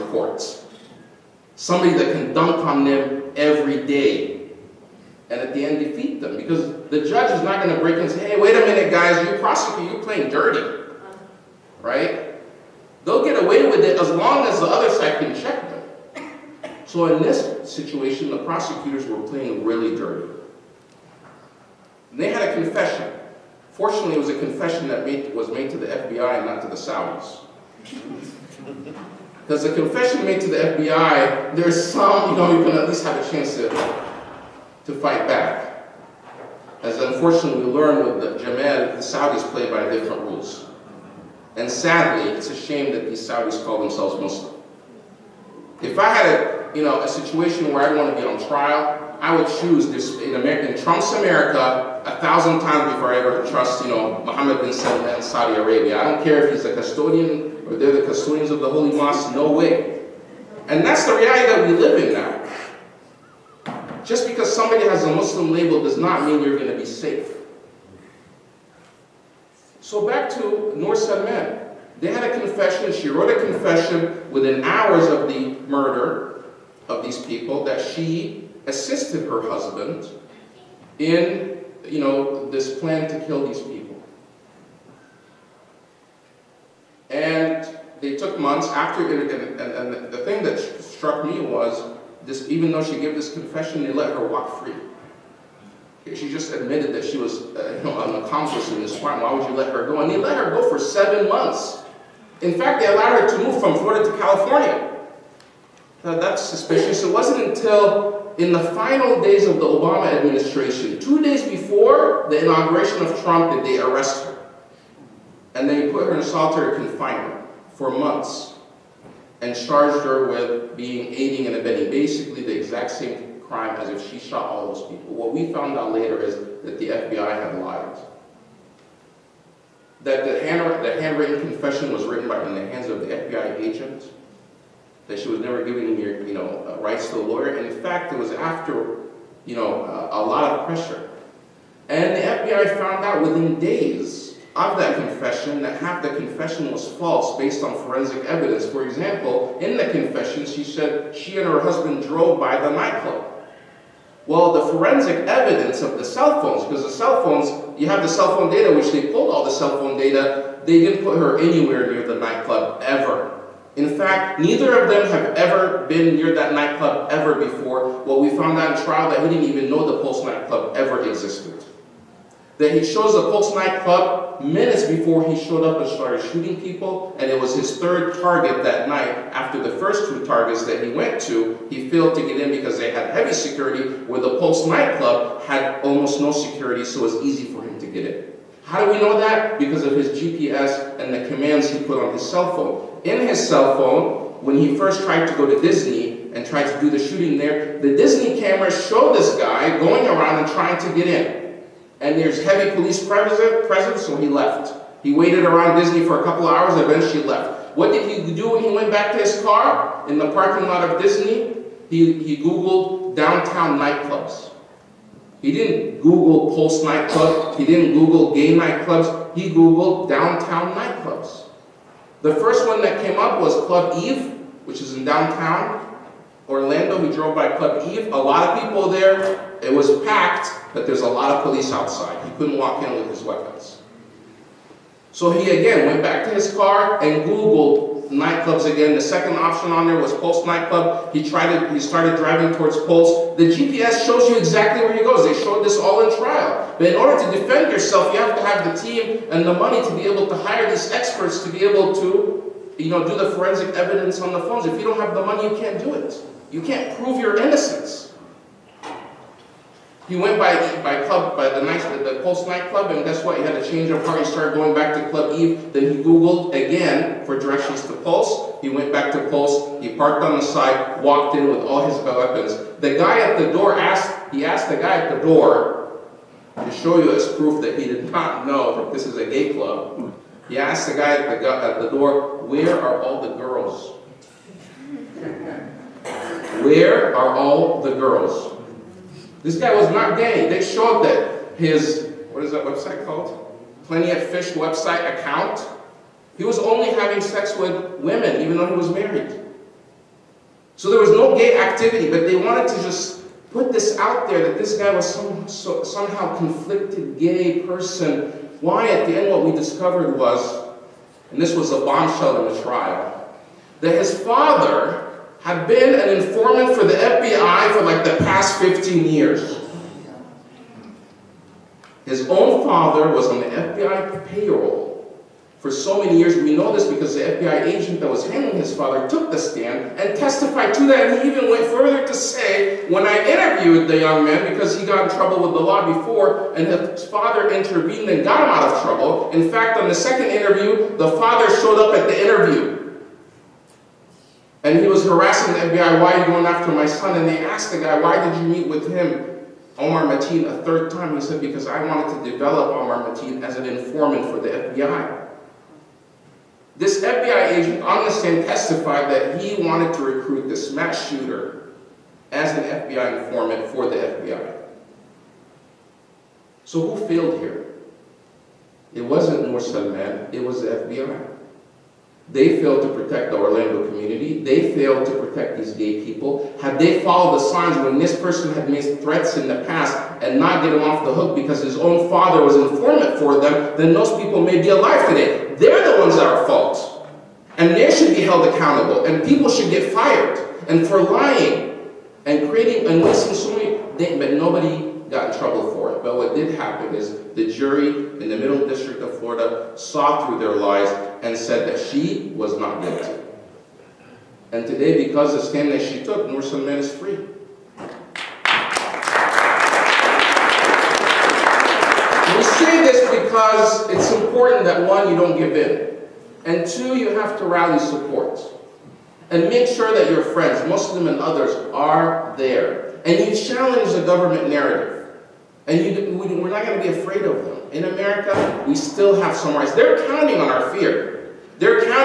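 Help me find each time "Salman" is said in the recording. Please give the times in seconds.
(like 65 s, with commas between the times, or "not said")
54 s, 70 s, 369 s, 406 s.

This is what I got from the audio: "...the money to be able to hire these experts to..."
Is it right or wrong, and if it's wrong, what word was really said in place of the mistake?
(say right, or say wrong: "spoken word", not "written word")
right.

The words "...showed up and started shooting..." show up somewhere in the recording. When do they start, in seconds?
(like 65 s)
175 s.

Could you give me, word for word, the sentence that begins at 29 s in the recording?
Because the confession made to the FBI, there's some, you know, you can at least have a chance to, to fight back.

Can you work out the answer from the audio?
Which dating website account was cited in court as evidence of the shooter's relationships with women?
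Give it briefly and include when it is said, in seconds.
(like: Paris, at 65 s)
Plenty of Fish, at 293 s.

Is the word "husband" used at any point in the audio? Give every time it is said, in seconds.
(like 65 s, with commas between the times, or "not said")
79 s, 151 s.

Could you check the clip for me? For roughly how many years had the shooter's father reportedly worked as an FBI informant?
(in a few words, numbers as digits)
15.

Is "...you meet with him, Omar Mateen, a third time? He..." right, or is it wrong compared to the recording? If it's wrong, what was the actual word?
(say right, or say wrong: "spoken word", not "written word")
right.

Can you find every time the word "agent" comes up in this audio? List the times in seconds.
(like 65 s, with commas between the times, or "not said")
133 s, 327 s, 357 s.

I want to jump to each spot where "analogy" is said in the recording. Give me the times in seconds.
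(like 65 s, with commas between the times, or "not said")
not said.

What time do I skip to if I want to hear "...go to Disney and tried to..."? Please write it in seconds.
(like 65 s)
195 s.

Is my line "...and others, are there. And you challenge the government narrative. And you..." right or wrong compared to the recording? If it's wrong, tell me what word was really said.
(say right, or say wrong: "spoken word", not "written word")
right.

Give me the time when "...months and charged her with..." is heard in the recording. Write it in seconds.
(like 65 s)
117 s.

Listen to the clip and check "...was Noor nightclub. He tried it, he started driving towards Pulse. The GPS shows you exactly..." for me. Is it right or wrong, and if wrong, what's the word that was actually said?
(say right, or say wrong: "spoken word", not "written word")
wrong: "Pulse", not "Noor".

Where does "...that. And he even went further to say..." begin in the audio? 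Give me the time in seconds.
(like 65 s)
330 s.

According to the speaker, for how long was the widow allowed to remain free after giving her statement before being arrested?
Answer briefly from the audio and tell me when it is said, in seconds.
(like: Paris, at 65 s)
7 months, at 100 s.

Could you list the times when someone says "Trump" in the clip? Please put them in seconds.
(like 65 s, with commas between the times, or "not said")
50 s, 113 s.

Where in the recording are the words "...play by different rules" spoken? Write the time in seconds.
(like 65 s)
39 s.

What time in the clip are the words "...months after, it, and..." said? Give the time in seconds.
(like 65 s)
88 s.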